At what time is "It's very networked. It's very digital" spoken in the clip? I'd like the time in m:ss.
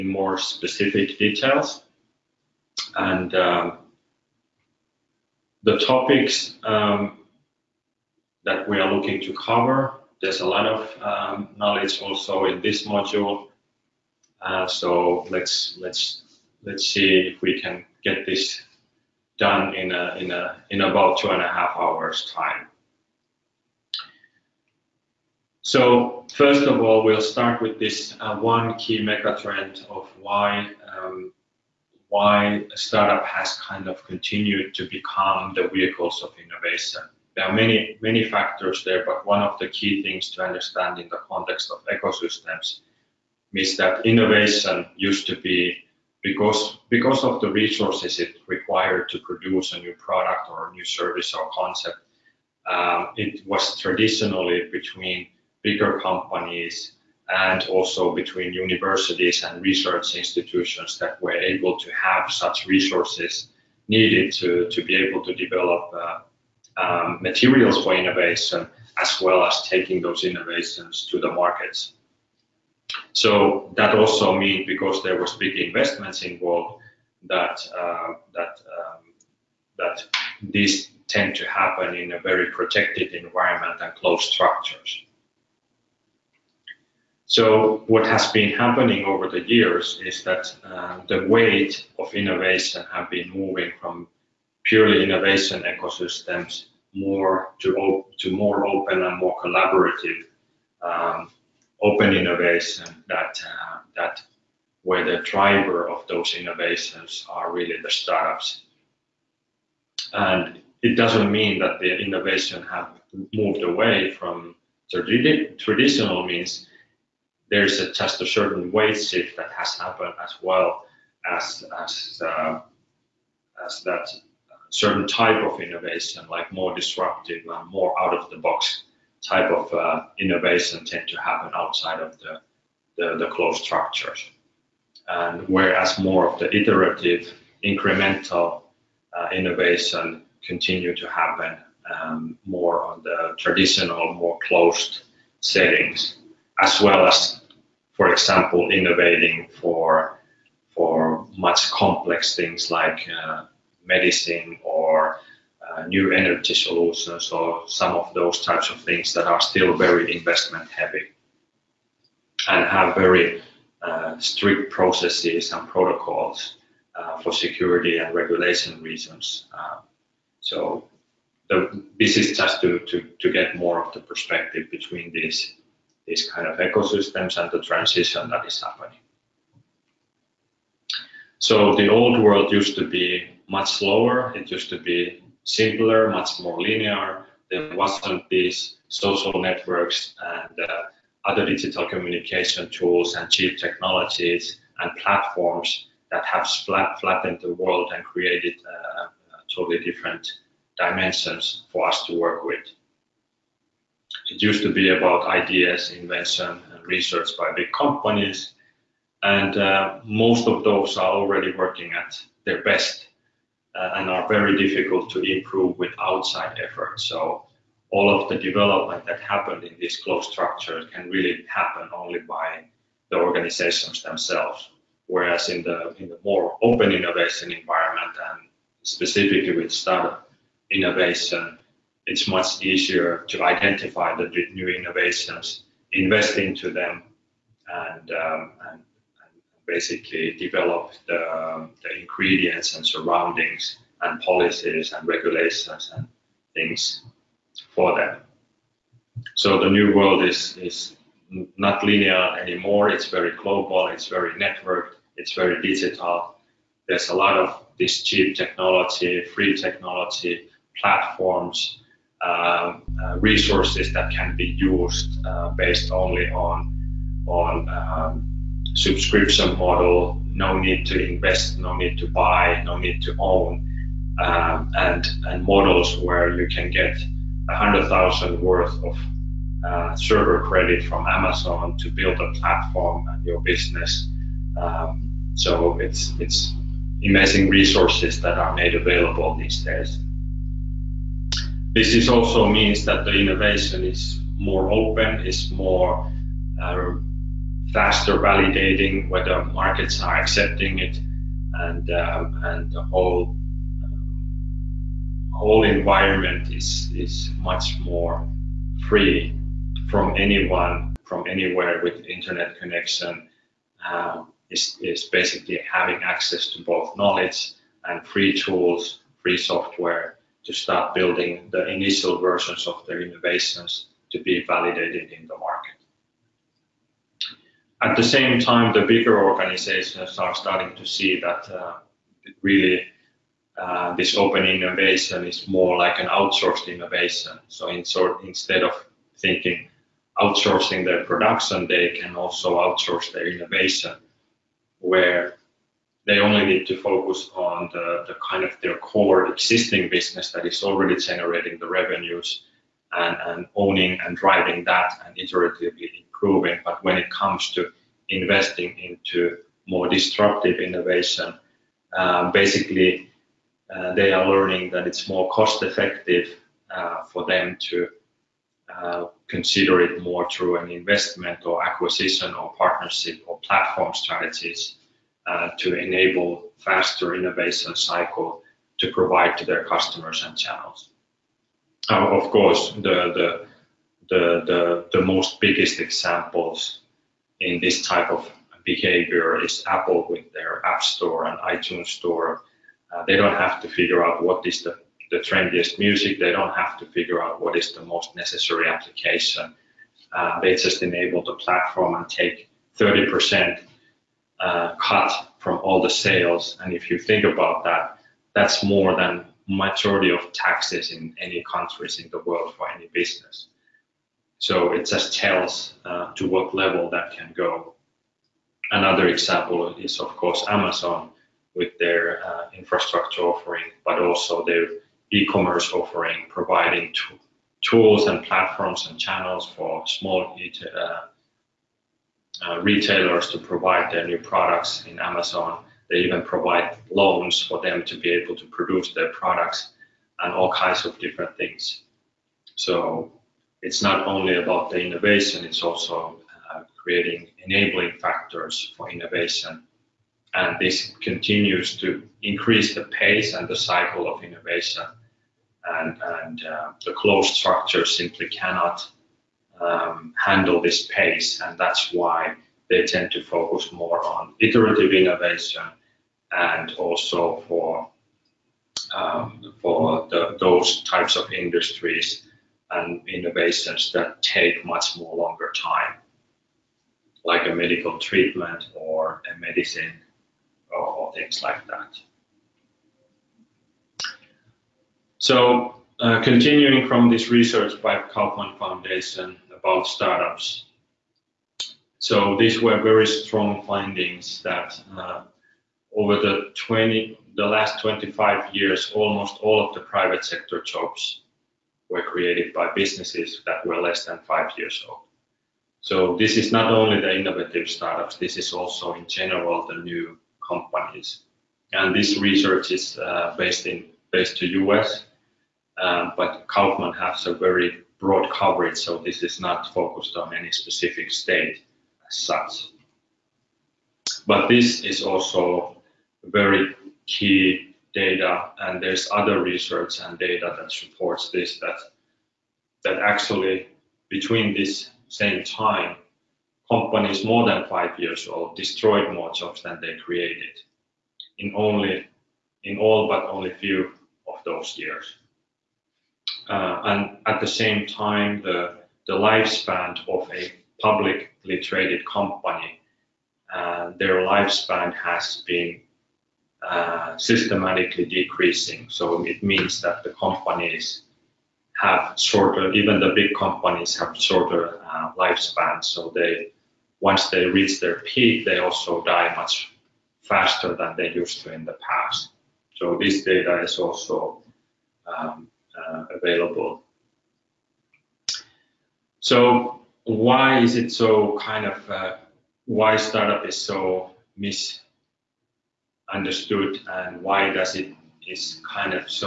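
4:13.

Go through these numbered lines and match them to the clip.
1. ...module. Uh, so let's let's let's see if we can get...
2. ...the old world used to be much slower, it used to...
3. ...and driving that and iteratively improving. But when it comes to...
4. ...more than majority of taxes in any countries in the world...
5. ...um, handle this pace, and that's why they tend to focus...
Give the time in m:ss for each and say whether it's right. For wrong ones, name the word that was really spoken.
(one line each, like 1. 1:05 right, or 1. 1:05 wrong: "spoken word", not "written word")
1. 0:12 right
2. 3:01 right
3. 5:54 right
4. 6:48 right
5. 7:39 right.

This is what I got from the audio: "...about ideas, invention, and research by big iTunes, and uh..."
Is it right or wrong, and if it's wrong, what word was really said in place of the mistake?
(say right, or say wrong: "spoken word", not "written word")
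wrong: "companies", not "iTunes".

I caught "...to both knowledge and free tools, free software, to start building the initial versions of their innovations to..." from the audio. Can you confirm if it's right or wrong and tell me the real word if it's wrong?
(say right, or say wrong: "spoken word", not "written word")
right.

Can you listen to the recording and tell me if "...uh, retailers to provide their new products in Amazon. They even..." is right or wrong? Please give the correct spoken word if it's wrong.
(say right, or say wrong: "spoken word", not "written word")
right.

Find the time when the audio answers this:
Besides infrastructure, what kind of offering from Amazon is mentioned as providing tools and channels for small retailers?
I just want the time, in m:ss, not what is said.
7:05.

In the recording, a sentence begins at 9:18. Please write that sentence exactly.
So it means that the companies have shorter, even the big companies have shorter uh, lifespans.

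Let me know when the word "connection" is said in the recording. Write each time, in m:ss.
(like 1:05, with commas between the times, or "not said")
5:12.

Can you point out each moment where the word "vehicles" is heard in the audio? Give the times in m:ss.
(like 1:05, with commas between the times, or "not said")
0:35.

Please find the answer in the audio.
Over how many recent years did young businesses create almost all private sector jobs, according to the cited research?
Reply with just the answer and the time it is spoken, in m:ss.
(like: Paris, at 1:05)
25 years, at 8:17.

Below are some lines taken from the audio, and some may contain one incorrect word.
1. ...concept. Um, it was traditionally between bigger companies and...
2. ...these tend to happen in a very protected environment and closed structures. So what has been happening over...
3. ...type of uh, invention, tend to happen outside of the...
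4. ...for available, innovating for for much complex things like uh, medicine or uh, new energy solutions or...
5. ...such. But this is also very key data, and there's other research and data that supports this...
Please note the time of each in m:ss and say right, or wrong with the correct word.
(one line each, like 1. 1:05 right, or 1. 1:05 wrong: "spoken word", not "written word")
1. 0:51 right
2. 1:20 right
3. 2:09 wrong: "innovation", not "invention"
4. 2:27 wrong: "example", not "available"
5. 8:42 right.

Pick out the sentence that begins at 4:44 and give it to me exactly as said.
Um, so it's it's amazing resources that are made available these days.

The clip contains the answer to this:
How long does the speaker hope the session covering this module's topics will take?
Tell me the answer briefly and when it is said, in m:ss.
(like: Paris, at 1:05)
2.5 hours, at 0:21.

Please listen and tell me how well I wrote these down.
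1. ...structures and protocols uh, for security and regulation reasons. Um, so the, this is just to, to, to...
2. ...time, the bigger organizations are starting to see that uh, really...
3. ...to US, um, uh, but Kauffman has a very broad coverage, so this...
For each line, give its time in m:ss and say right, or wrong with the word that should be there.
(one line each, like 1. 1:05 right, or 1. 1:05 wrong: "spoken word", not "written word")
1. 2:44 wrong: "processes", not "structures"
2. 5:28 right
3. 8:34 right.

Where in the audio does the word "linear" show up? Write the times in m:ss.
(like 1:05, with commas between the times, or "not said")
3:06, 4:11.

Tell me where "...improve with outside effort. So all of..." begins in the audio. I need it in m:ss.
3:35.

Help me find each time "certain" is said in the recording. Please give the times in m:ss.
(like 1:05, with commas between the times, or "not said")
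1:58, 2:04.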